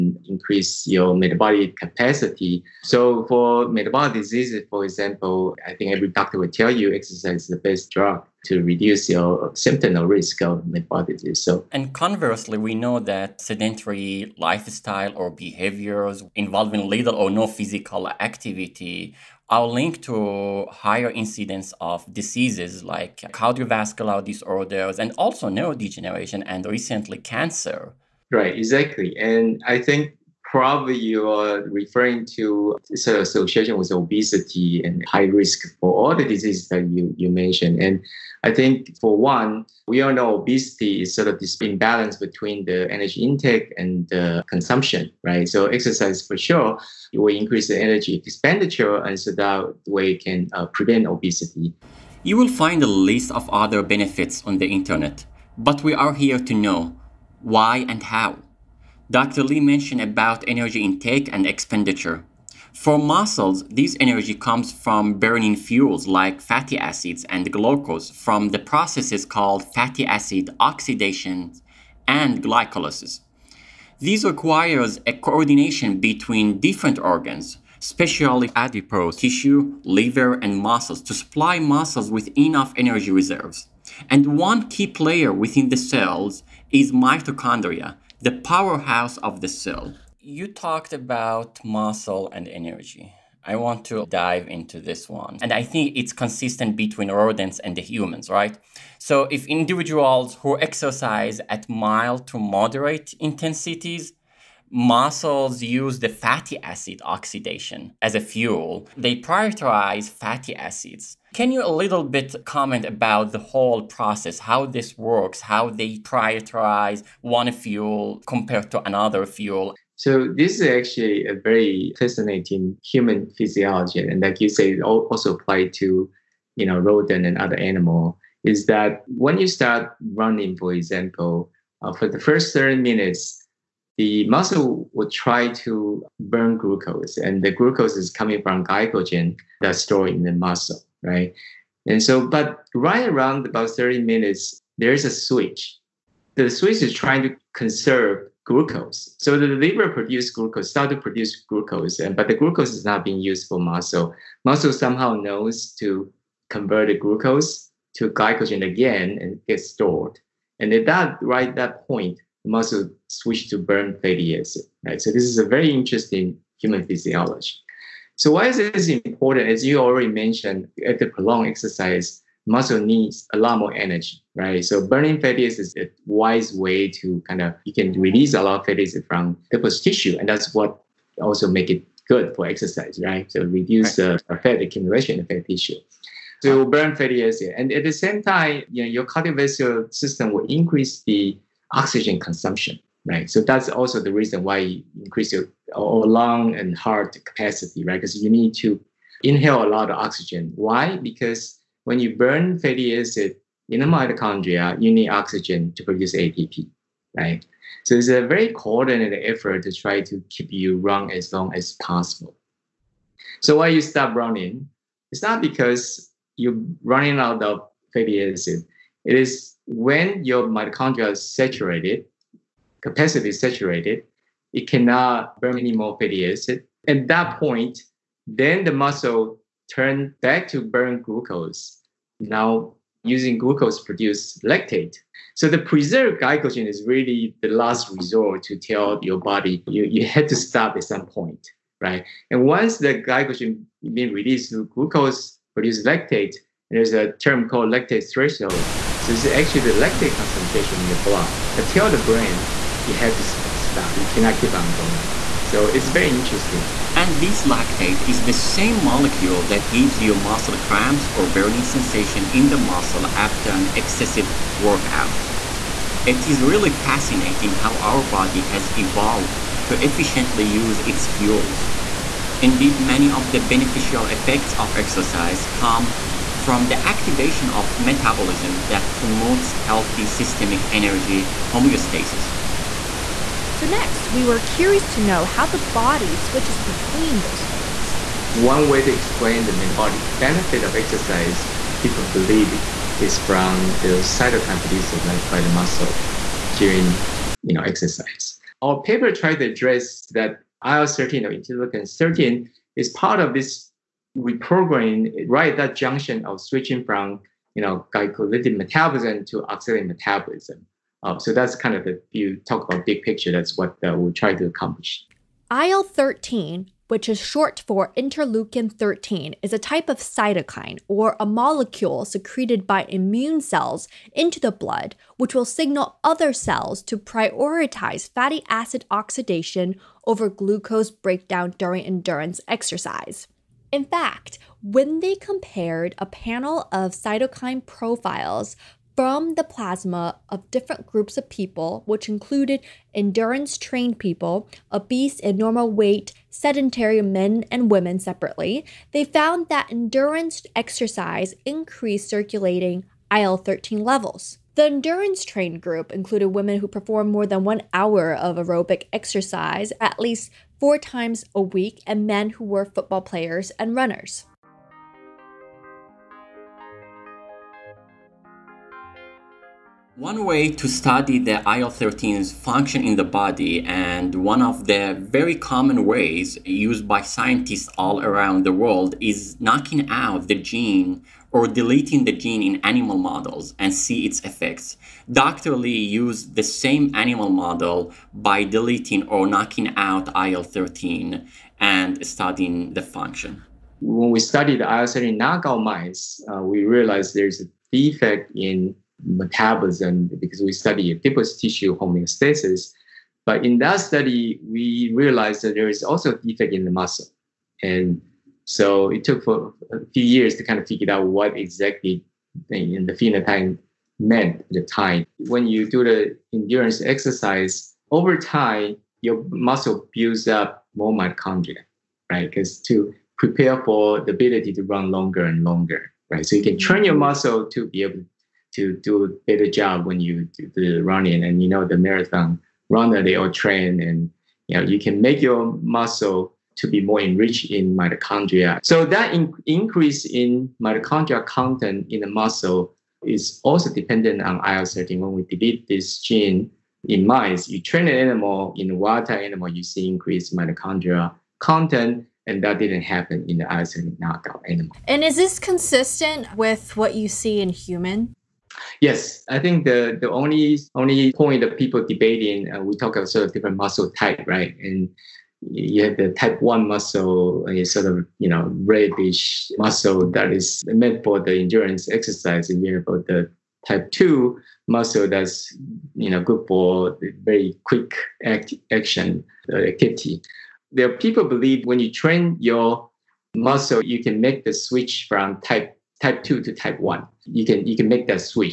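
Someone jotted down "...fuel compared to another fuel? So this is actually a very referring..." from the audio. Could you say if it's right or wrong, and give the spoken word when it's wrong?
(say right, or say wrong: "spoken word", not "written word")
wrong: "fascinating", not "referring".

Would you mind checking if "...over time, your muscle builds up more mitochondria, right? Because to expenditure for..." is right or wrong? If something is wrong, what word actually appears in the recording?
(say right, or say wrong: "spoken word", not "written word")
wrong: "prepare", not "expenditure".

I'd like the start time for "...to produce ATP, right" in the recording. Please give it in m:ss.
3:25.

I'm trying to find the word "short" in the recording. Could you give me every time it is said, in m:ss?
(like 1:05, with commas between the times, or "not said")
5:17.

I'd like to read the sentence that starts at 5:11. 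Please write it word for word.
Uh, so that's kind of the you talk about big picture.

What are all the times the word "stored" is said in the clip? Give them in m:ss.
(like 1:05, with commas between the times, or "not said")
2:19, 2:39.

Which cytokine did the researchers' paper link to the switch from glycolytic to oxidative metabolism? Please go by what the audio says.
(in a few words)
interleukin 13.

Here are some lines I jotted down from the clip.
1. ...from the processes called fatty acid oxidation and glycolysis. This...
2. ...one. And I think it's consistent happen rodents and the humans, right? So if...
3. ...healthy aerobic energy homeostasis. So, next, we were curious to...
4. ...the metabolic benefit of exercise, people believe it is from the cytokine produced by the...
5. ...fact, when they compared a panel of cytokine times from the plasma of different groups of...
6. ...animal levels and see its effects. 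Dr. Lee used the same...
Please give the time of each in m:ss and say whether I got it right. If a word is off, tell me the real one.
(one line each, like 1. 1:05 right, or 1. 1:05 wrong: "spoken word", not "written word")
1. 1:08 right
2. 1:35 wrong: "between", not "happen"
3. 4:39 wrong: "systemic", not "aerobic"
4. 4:49 right
5. 5:33 wrong: "profiles", not "times"
6. 6:22 wrong: "models", not "levels".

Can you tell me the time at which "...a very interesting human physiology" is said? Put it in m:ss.
2:45.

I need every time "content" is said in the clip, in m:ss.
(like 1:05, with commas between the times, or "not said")
7:21, 7:31.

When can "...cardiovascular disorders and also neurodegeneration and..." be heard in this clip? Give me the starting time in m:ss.
0:23.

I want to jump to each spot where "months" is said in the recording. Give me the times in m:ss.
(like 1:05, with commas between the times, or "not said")
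not said.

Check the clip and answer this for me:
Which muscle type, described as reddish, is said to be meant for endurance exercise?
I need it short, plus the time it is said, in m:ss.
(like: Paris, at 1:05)
type 1, at 7:46.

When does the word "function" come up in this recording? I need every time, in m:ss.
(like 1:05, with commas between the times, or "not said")
6:12, 6:32.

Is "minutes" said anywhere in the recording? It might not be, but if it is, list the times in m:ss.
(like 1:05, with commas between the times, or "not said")
2:12, 2:24.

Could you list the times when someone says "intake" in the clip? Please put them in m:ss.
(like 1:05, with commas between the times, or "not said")
0:43, 1:00.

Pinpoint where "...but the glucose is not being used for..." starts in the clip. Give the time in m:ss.
2:32.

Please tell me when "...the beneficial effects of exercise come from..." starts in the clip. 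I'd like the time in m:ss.
4:33.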